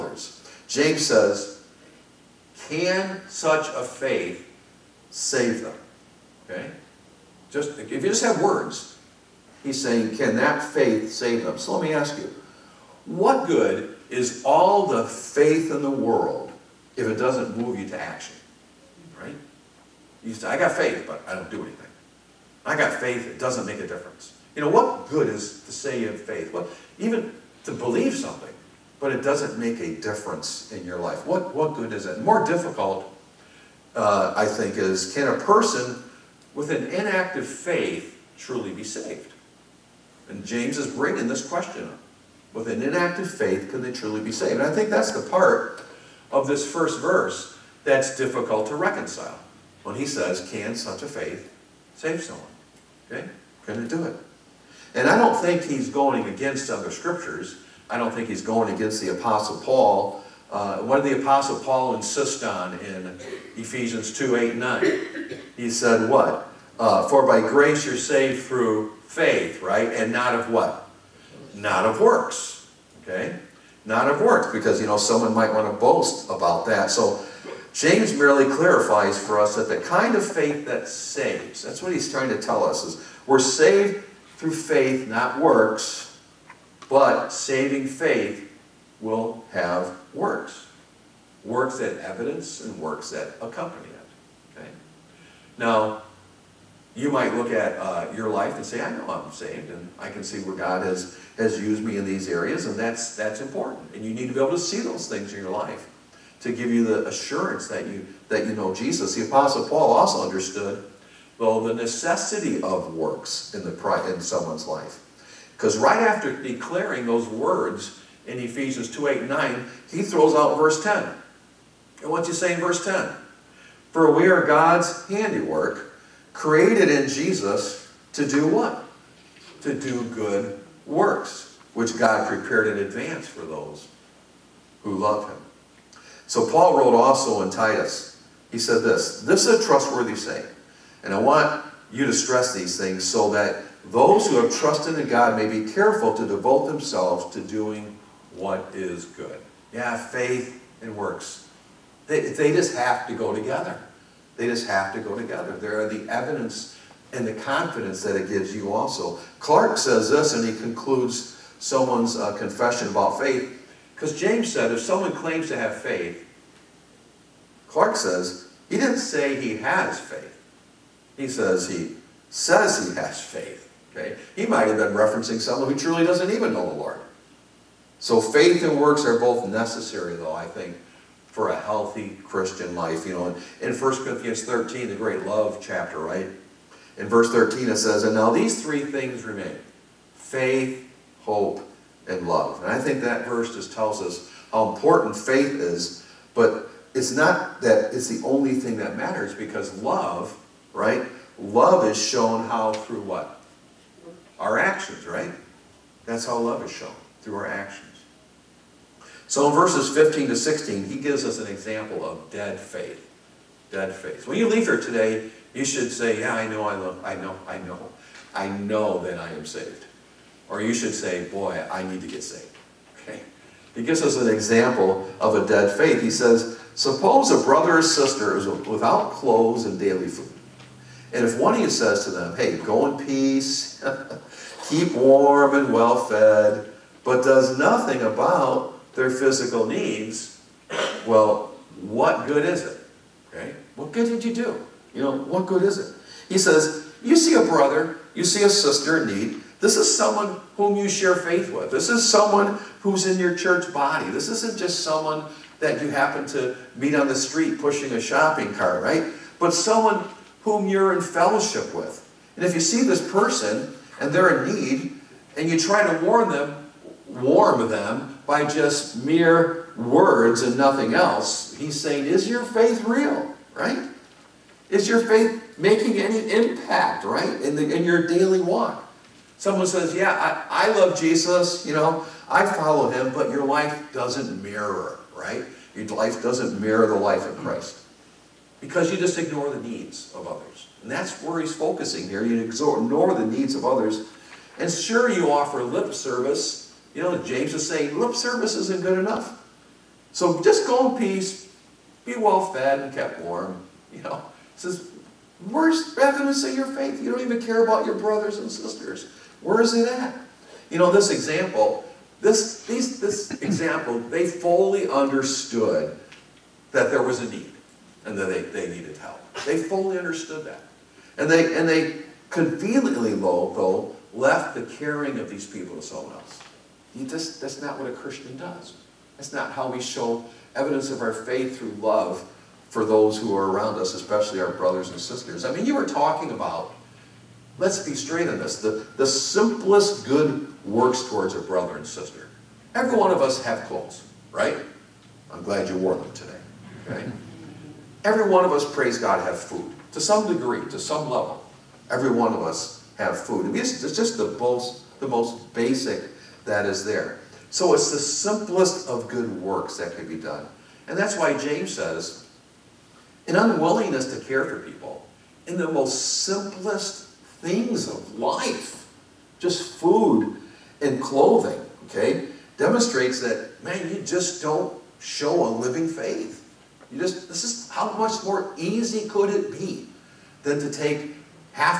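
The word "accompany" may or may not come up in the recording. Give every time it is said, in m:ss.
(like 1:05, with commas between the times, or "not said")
1:33.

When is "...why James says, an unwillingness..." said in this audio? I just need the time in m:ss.
6:01.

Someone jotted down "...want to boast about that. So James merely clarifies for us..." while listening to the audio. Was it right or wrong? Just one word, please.
right.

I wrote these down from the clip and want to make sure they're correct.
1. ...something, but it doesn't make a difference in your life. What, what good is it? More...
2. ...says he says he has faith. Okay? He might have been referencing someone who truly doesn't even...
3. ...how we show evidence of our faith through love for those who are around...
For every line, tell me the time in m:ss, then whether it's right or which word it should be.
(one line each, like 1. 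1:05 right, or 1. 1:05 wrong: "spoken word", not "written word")
1. 0:28 right
2. 2:51 right
3. 5:29 right.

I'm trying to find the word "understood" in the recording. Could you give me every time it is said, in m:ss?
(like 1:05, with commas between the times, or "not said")
1:50, 5:14, 5:19.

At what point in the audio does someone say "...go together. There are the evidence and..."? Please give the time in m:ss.
2:34.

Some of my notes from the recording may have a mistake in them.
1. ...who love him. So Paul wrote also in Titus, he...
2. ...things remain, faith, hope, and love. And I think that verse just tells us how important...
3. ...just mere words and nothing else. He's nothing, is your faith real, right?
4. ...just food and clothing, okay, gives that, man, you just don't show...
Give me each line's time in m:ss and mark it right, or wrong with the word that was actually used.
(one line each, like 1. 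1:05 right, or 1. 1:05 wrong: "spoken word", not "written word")
1. 2:14 right
2. 3:08 right
3. 4:28 wrong: "saying", not "nothing"
4. 6:09 wrong: "demonstrates", not "gives".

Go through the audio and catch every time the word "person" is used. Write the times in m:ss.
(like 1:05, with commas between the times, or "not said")
0:35, 4:23.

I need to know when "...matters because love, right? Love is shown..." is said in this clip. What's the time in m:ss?
3:18.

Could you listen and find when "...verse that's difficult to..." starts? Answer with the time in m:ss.
0:47.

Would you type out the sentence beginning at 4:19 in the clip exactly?
But someone whom you're in fellowship with.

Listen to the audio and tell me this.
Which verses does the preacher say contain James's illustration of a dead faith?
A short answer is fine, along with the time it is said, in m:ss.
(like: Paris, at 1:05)
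15 to 16, at 3:29.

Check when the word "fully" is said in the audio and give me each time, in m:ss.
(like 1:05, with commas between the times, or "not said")
5:14, 5:19.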